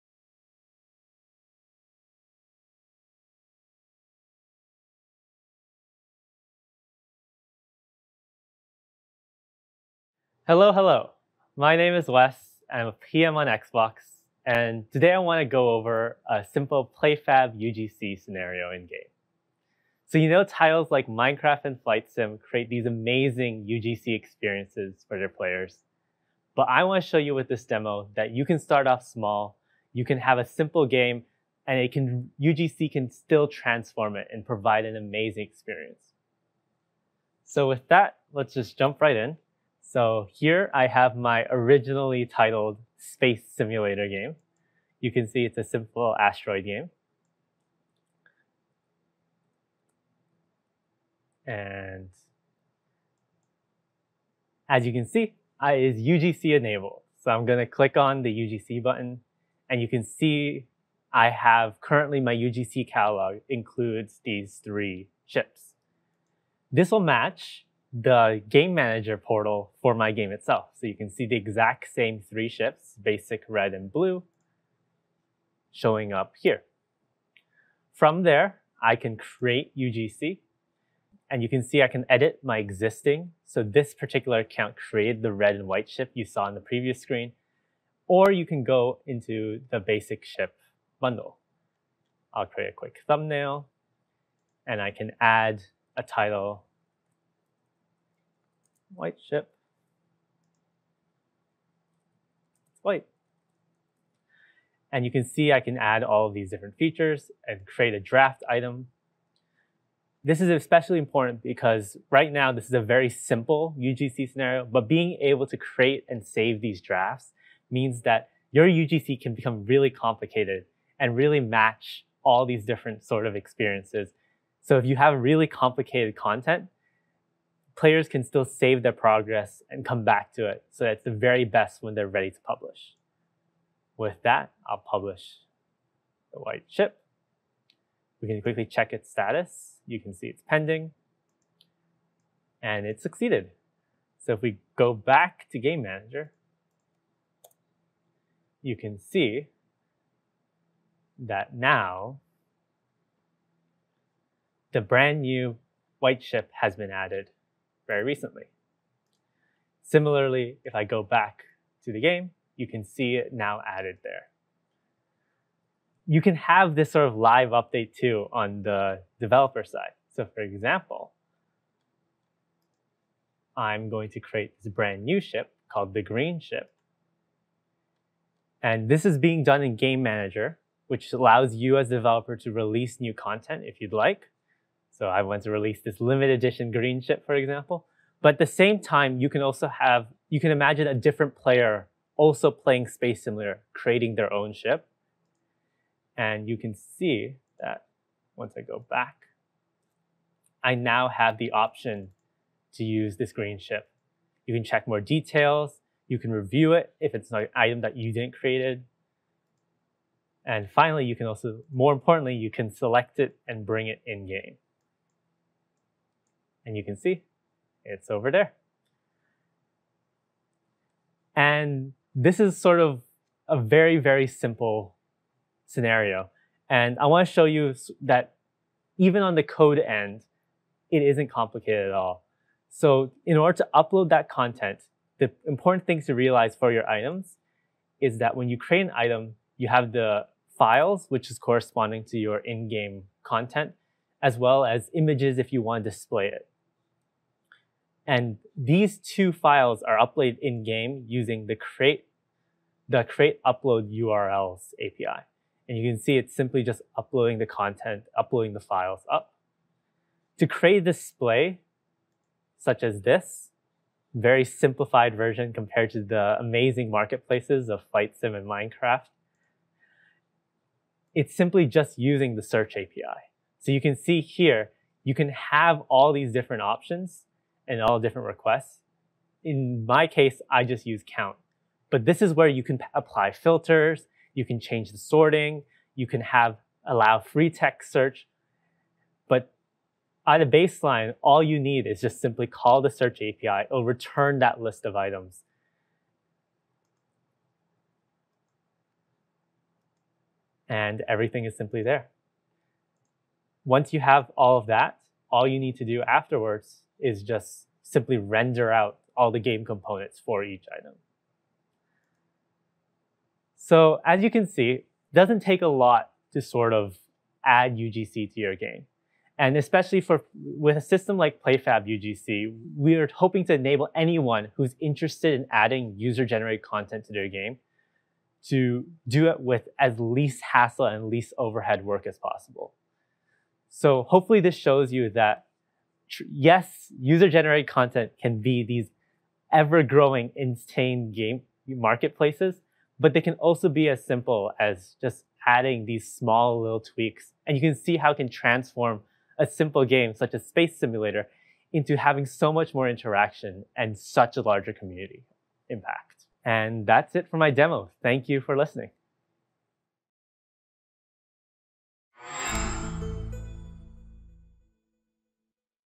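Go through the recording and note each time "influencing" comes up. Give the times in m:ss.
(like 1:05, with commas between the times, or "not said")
not said.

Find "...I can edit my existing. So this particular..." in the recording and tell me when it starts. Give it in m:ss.
1:21.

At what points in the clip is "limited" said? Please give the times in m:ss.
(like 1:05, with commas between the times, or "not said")
3:06.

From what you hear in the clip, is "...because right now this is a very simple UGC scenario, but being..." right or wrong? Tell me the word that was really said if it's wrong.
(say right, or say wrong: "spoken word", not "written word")
right.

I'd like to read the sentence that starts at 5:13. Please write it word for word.
So as you can see, it doesn't take a lot to sort of add UGC to your game.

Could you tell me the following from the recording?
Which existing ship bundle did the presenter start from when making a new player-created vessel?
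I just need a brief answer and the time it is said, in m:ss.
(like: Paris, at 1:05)
basic ship bundle, at 1:29.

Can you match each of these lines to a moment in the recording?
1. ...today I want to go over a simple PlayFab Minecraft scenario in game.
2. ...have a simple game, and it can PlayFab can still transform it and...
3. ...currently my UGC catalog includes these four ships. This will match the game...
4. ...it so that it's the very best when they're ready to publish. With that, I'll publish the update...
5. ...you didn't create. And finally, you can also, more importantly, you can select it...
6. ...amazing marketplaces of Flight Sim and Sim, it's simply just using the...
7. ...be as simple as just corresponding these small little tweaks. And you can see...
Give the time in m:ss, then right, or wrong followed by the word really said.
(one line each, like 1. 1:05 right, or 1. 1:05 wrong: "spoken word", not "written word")
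1. 0:14 wrong: "UGC", not "Minecraft"
2. 0:30 wrong: "UGC", not "PlayFab"
3. 1:01 wrong: "three", not "four"
4. 2:10 wrong: "white", not "update"
5. 3:27 right
6. 4:26 wrong: "Minecraft", not "Sim"
7. 5:43 wrong: "adding", not "corresponding".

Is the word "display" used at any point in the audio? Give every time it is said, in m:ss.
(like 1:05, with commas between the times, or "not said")
4:05, 4:20.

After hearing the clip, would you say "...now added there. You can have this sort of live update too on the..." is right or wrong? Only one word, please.
right.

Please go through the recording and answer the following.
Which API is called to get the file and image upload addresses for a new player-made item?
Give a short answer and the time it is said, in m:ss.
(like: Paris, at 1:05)
create upload URLs, at 4:13.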